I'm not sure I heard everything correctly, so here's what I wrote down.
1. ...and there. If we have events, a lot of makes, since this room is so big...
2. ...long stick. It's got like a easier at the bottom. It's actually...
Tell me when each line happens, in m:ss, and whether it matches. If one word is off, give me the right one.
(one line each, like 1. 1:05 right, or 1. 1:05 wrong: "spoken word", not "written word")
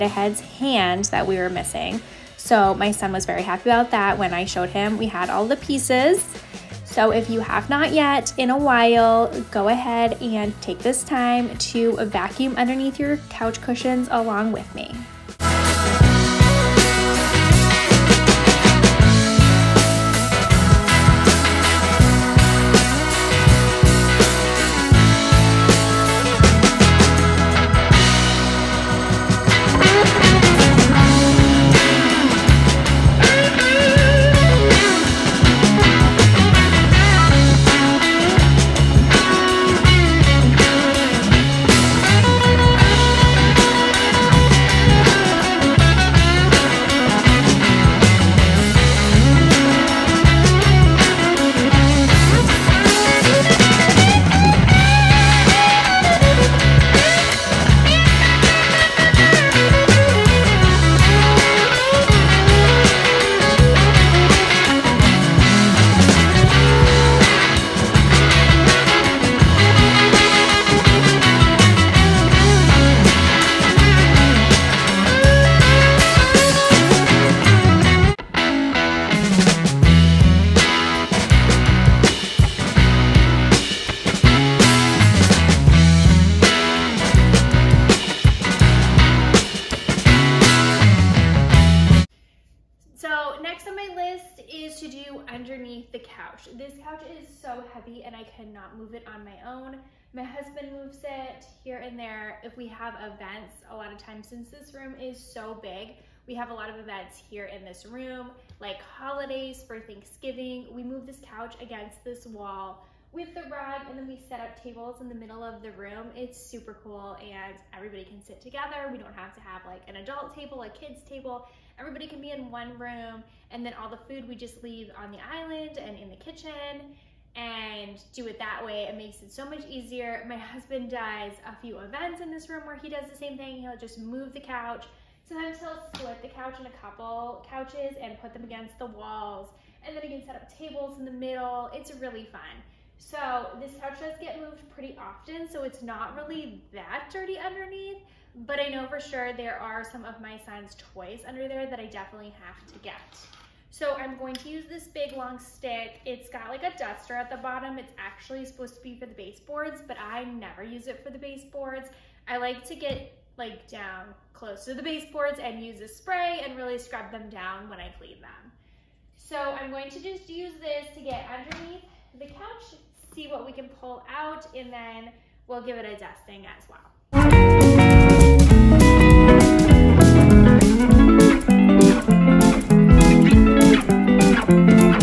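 1. 1:41 wrong: "times", not "makes"
2. 2:35 wrong: "duster", not "easier".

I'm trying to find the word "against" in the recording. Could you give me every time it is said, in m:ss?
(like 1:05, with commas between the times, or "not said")
1:51, 2:18.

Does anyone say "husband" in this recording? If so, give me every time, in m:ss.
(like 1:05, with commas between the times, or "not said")
1:40, 2:10.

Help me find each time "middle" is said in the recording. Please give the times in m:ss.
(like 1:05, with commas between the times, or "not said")
1:55, 2:21.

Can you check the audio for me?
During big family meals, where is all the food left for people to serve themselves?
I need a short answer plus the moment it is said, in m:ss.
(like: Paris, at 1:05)
the island, at 2:05.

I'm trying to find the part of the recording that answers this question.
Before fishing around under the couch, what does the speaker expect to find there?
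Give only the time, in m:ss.
2:30.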